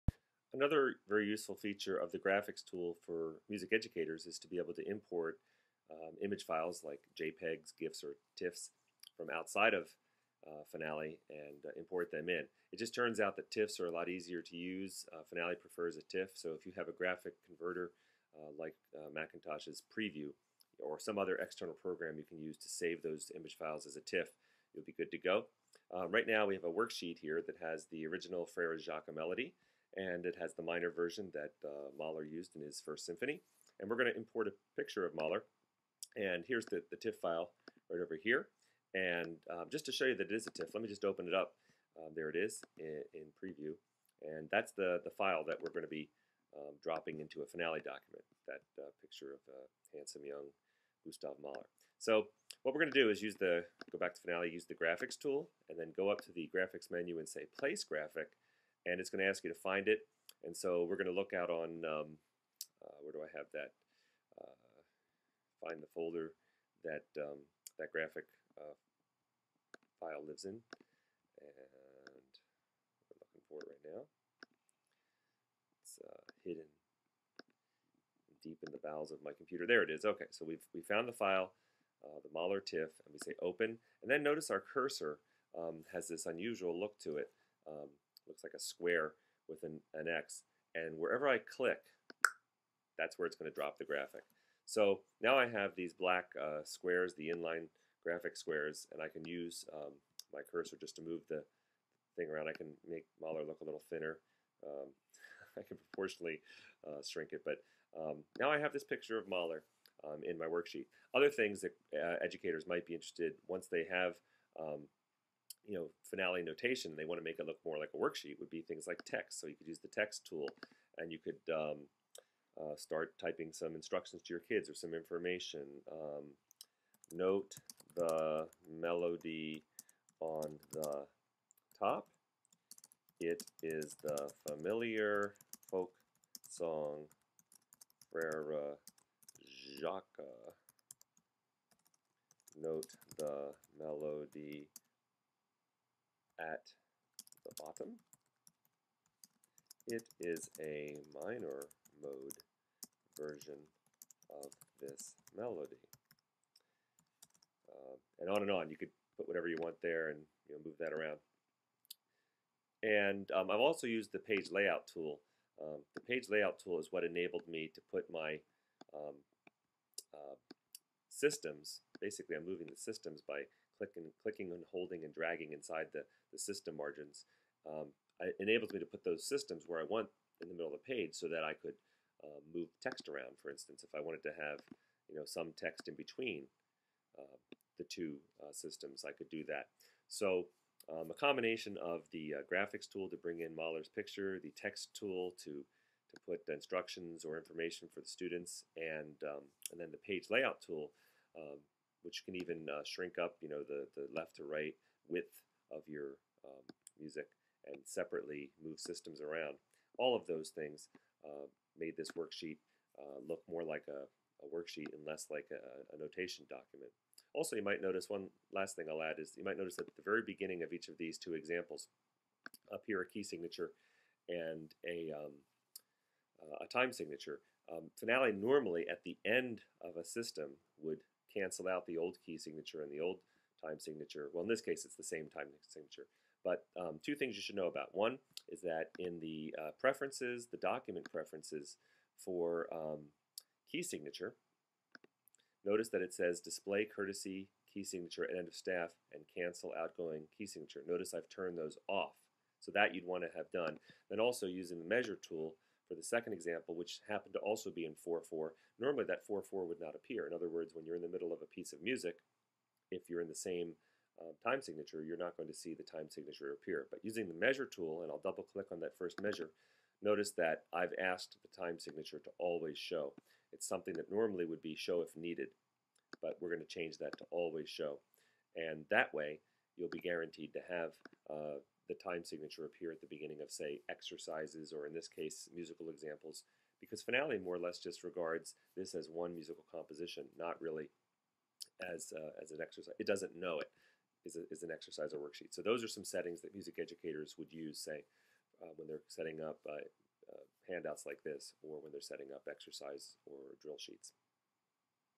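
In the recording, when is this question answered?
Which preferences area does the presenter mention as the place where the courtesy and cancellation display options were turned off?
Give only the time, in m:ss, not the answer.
4:00.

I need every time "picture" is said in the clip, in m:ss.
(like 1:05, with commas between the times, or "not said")
0:34, 0:49, 1:48, 3:13.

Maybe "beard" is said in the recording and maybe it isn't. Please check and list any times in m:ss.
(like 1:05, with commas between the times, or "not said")
not said.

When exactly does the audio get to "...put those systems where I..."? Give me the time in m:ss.
2:58.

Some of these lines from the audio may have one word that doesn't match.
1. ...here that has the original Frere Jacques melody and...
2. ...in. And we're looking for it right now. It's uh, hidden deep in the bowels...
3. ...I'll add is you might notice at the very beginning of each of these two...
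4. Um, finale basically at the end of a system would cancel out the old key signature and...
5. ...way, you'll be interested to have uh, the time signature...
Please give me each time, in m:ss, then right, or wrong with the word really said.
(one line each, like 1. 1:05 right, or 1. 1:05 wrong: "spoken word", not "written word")
1. 0:27 right
2. 1:10 right
3. 3:38 right
4. 3:47 wrong: "normally", not "basically"
5. 4:39 wrong: "guaranteed", not "interested".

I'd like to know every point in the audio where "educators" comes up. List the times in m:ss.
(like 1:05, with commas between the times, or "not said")
0:03, 1:52, 4:56.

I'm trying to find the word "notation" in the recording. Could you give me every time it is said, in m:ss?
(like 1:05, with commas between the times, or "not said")
1:56, 3:35.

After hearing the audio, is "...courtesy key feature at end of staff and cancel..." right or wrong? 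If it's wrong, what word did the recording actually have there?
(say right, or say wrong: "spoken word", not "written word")
wrong: "signature", not "feature".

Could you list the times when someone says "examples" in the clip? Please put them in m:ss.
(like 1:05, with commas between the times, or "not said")
3:41, 4:16, 4:45.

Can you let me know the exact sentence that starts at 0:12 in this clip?
It just turns out that TIFFs are a lot easier to use.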